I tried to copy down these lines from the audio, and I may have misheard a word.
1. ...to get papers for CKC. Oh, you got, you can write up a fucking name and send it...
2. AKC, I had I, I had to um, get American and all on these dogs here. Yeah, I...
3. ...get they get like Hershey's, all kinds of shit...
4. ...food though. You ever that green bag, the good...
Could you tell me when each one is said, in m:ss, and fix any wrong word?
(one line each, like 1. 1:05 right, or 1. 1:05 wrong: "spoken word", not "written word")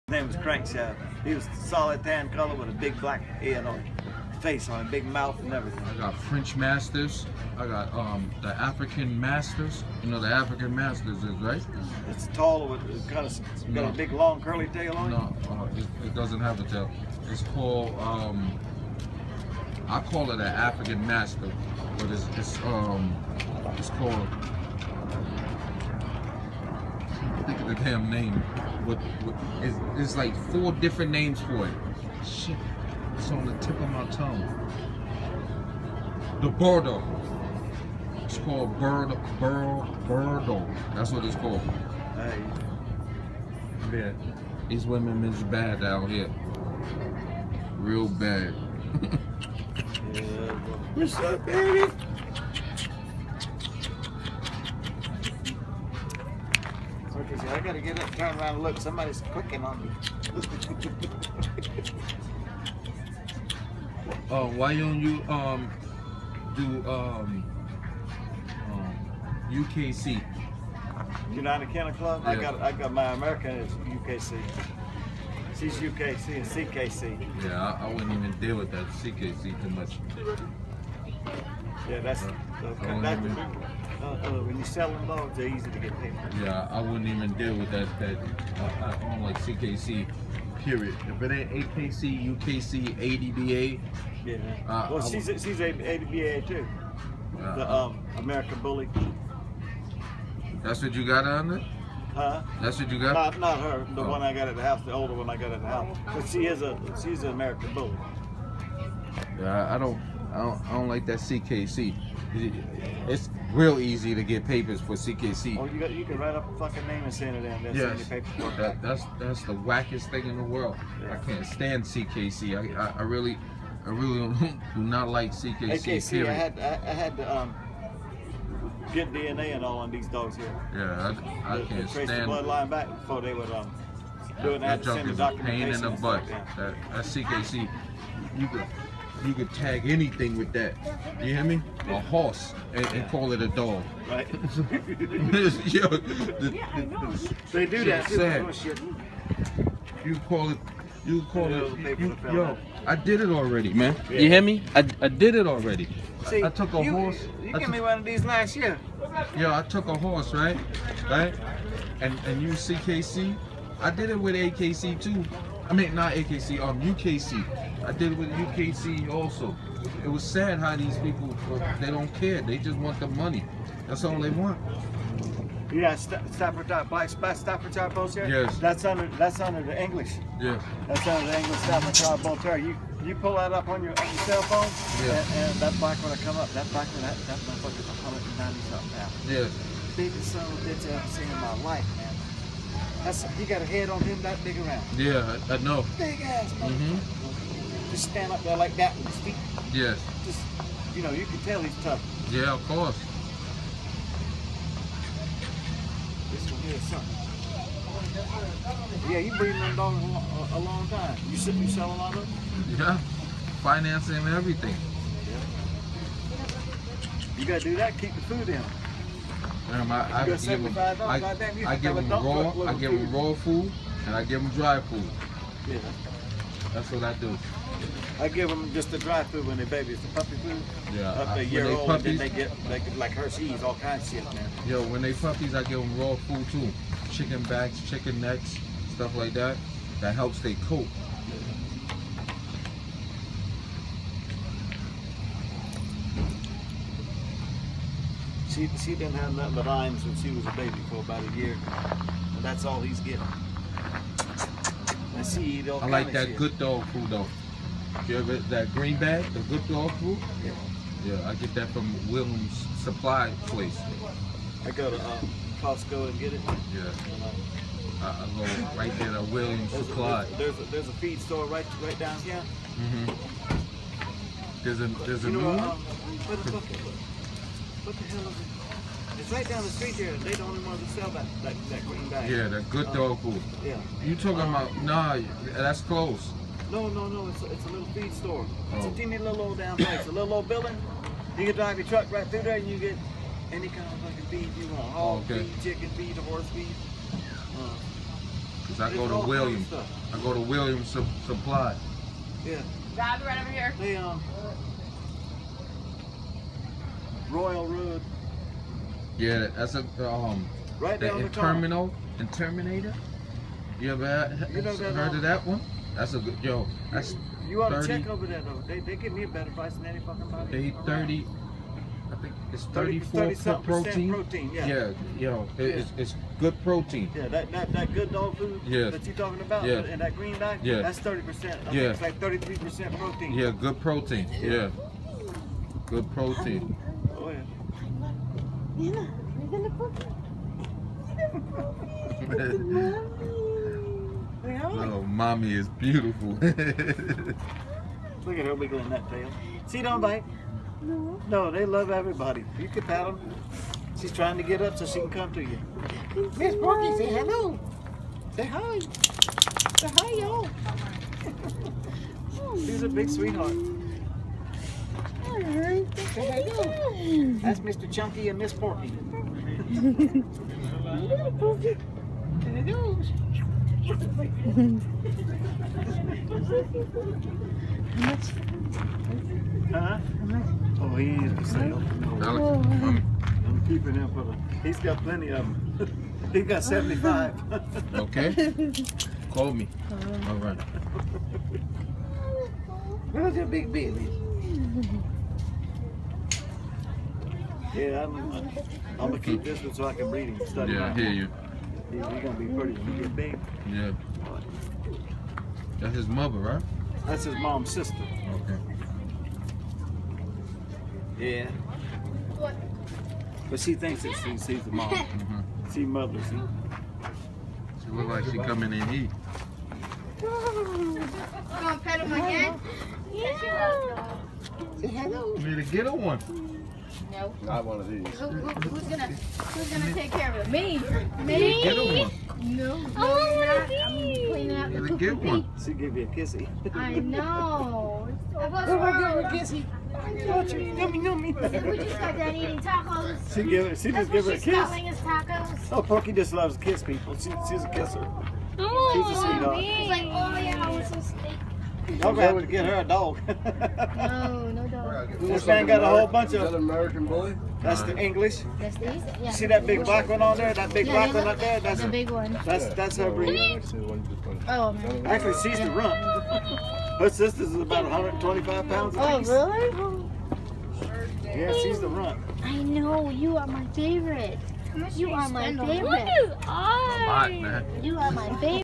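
1. 1:54 right
2. 2:05 wrong: "DNA", not "American"
3. 3:52 right
4. 4:16 right.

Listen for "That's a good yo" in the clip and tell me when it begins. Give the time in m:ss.
5:15.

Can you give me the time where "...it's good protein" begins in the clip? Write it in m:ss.
5:25.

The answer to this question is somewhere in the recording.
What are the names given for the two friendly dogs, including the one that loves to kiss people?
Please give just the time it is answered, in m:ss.
6:07.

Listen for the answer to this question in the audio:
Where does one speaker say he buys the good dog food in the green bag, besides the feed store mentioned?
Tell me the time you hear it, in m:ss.
4:25.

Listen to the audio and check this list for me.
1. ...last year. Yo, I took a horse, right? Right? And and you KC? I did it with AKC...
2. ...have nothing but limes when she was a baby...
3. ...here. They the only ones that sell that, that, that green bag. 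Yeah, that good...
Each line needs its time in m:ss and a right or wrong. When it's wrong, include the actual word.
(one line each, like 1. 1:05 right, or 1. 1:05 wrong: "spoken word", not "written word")
1. 2:38 right
2. 4:09 right
3. 4:39 right.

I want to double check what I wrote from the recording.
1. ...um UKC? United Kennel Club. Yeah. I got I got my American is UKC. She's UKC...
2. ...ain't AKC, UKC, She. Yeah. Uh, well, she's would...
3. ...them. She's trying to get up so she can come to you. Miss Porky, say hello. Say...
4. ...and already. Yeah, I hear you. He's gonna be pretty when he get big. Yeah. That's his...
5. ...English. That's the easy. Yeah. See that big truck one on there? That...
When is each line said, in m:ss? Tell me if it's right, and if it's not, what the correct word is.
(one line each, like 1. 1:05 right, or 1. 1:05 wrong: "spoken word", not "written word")
1. 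1:08 right
2. 1:31 wrong: "ADBA", not "She"
3. 5:53 right
4. 6:40 wrong: "study", not "already"
5. 7:37 wrong: "black", not "truck".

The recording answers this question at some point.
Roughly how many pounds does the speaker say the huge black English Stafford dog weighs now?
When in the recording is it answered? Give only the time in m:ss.
3:07.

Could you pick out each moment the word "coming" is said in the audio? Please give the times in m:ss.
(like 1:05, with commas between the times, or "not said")
6:58.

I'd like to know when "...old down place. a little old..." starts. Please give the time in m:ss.
4:49.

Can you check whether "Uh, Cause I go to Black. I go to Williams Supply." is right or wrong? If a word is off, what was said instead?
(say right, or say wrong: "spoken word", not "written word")
wrong: "Williams", not "Black".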